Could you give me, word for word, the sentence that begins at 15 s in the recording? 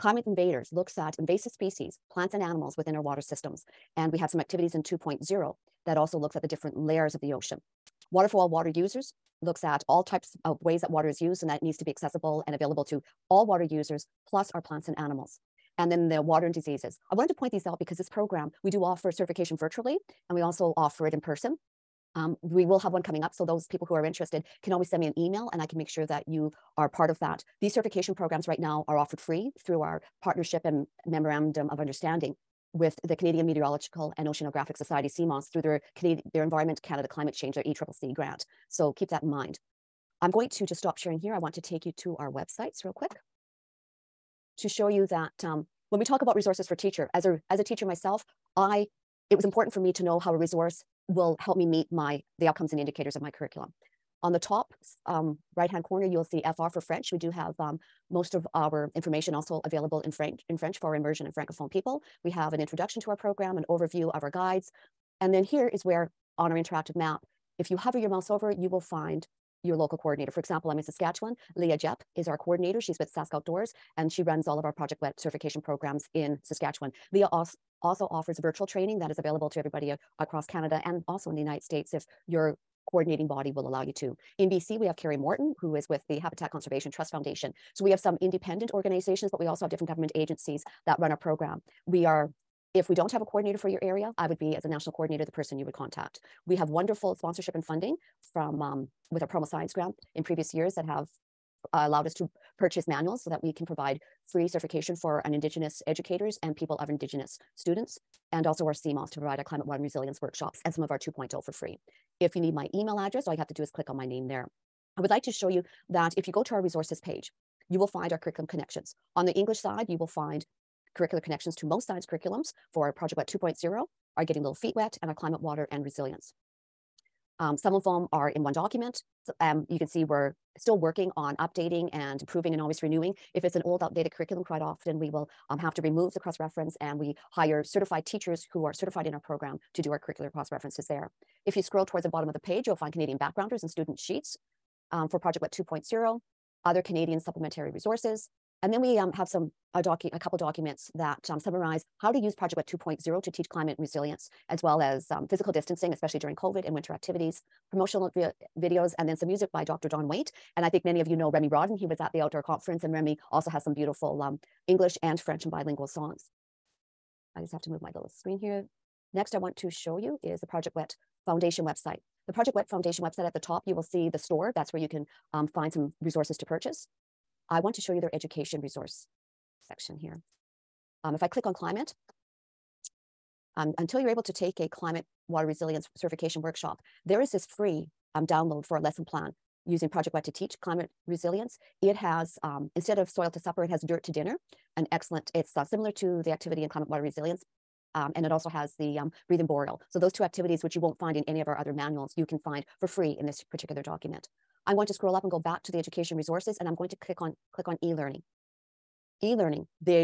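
And then the water and diseases.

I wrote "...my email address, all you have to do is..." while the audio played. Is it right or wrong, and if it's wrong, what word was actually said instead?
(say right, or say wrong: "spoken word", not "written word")
right.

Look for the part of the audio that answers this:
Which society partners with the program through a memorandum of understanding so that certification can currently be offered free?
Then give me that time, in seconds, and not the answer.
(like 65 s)
33 s.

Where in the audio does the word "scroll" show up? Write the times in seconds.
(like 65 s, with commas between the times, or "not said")
141 s, 204 s.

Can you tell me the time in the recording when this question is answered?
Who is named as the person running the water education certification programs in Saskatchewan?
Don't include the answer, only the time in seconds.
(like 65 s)
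71 s.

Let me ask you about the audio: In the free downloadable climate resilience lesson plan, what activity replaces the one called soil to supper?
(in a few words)
Dirt to Dinner.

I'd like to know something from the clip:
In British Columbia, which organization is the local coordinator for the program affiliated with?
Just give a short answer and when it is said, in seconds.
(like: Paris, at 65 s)
Habitat Conservation Trust Foundation, at 86 s.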